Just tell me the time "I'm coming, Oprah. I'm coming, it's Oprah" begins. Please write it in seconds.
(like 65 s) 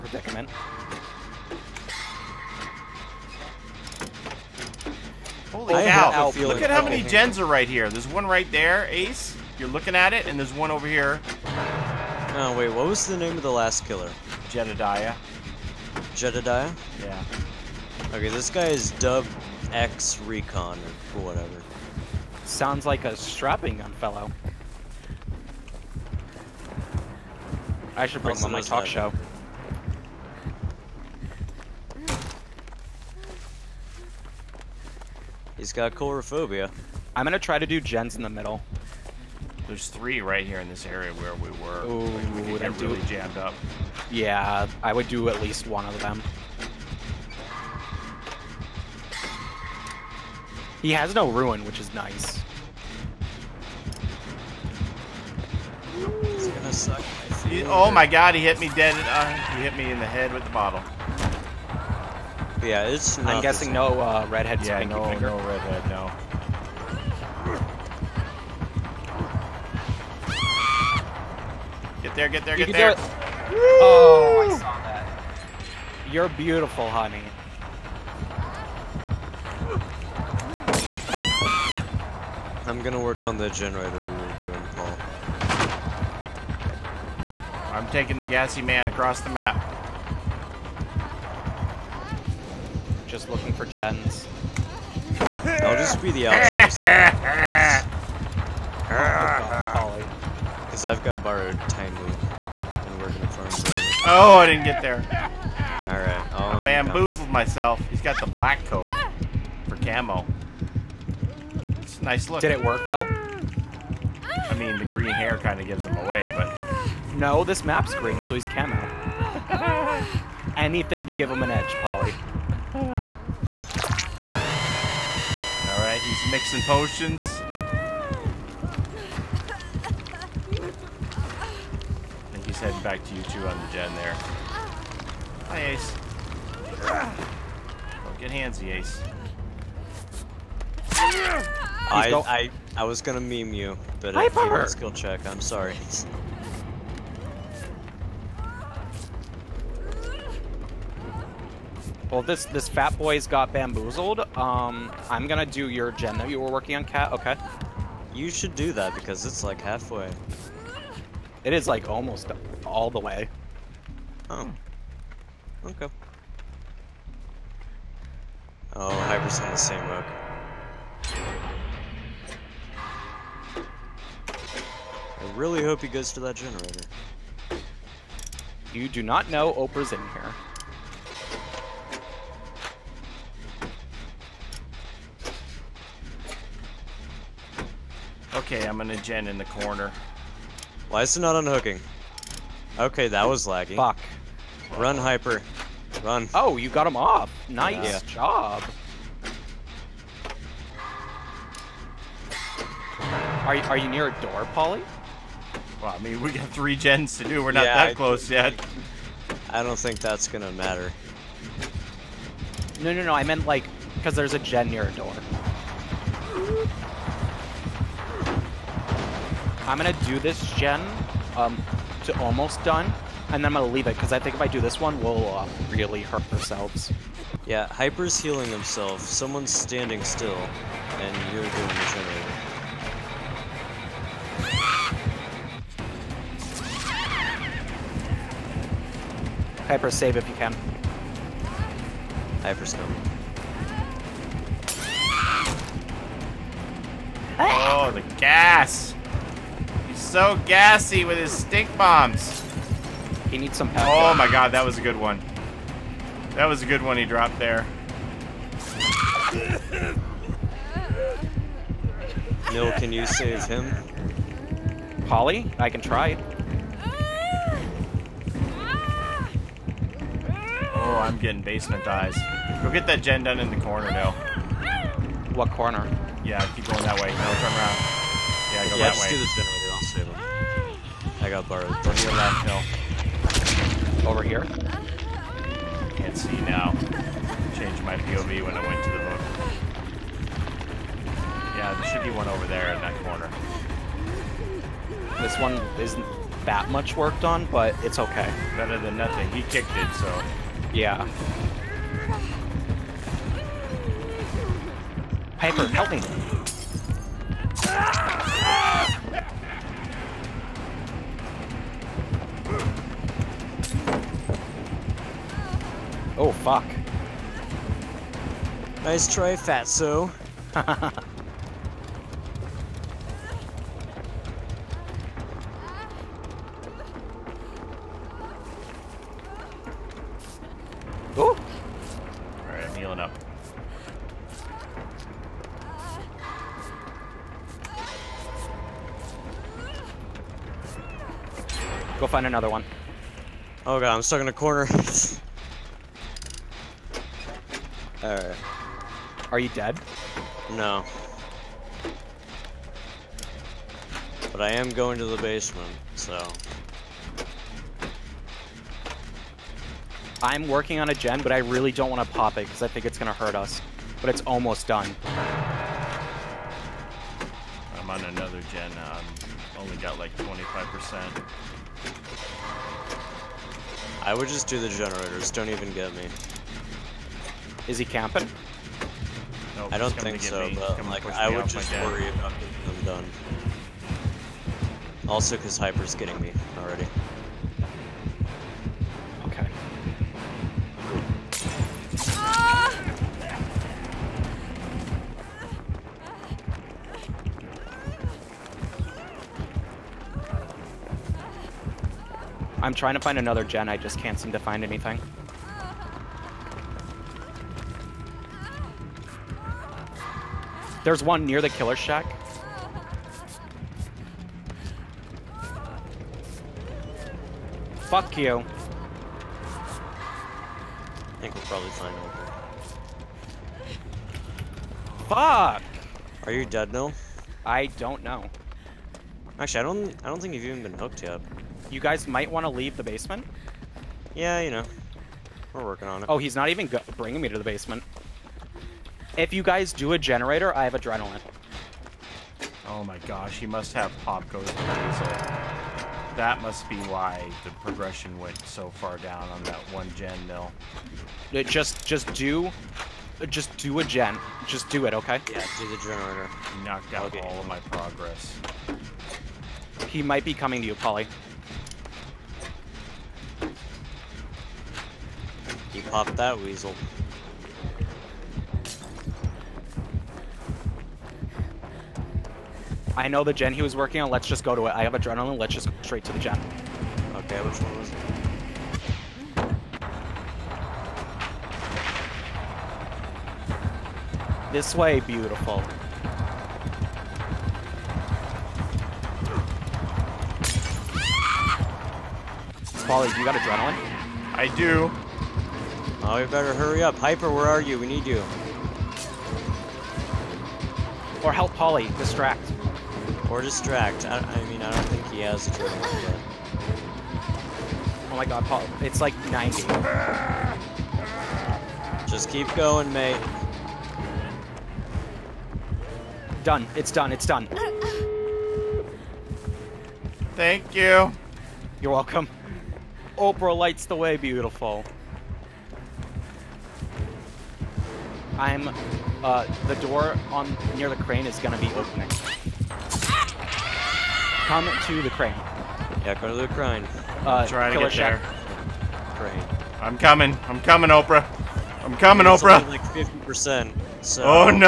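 540 s.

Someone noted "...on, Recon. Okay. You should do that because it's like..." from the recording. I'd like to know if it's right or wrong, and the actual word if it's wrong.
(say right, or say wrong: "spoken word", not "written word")
wrong: "Cat", not "Recon".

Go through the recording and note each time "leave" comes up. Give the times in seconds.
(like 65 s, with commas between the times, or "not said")
223 s, 432 s.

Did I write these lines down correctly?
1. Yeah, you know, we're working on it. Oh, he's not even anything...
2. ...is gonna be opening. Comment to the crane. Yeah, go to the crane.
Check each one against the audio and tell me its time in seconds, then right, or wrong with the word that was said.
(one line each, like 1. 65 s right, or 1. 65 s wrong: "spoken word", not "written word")
1. 434 s wrong: "bringing", not "anything"
2. 531 s right.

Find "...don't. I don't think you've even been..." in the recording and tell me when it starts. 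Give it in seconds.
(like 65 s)
429 s.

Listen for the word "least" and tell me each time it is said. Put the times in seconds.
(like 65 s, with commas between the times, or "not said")
45 s.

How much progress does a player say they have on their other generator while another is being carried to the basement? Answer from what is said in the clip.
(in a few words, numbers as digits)
25%.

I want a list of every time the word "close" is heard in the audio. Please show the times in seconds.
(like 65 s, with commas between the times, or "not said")
207 s.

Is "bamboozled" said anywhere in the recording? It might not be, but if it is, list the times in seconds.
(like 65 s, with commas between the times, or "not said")
106 s, 153 s.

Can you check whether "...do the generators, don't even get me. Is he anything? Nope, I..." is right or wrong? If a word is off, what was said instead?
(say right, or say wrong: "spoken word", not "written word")
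wrong: "camping", not "anything".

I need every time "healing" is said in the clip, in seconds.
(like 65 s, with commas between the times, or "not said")
228 s, 332 s.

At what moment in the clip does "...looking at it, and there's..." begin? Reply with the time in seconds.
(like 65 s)
9 s.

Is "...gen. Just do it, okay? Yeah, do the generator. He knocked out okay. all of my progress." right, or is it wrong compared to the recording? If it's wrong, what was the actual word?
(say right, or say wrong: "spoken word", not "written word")
right.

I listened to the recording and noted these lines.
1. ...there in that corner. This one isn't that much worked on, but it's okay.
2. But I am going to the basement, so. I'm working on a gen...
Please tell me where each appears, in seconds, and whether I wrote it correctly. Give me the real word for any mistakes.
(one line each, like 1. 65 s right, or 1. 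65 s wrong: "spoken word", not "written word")
1. 292 s right
2. 354 s right.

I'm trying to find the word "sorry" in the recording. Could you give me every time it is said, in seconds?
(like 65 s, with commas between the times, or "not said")
145 s.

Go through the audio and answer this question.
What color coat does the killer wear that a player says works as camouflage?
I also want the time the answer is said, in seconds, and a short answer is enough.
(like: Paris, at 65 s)
black, at 108 s.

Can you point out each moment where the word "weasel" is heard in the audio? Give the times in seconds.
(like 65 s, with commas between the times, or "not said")
444 s, 466 s.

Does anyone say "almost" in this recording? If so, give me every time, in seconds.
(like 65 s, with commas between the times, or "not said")
161 s, 222 s, 364 s.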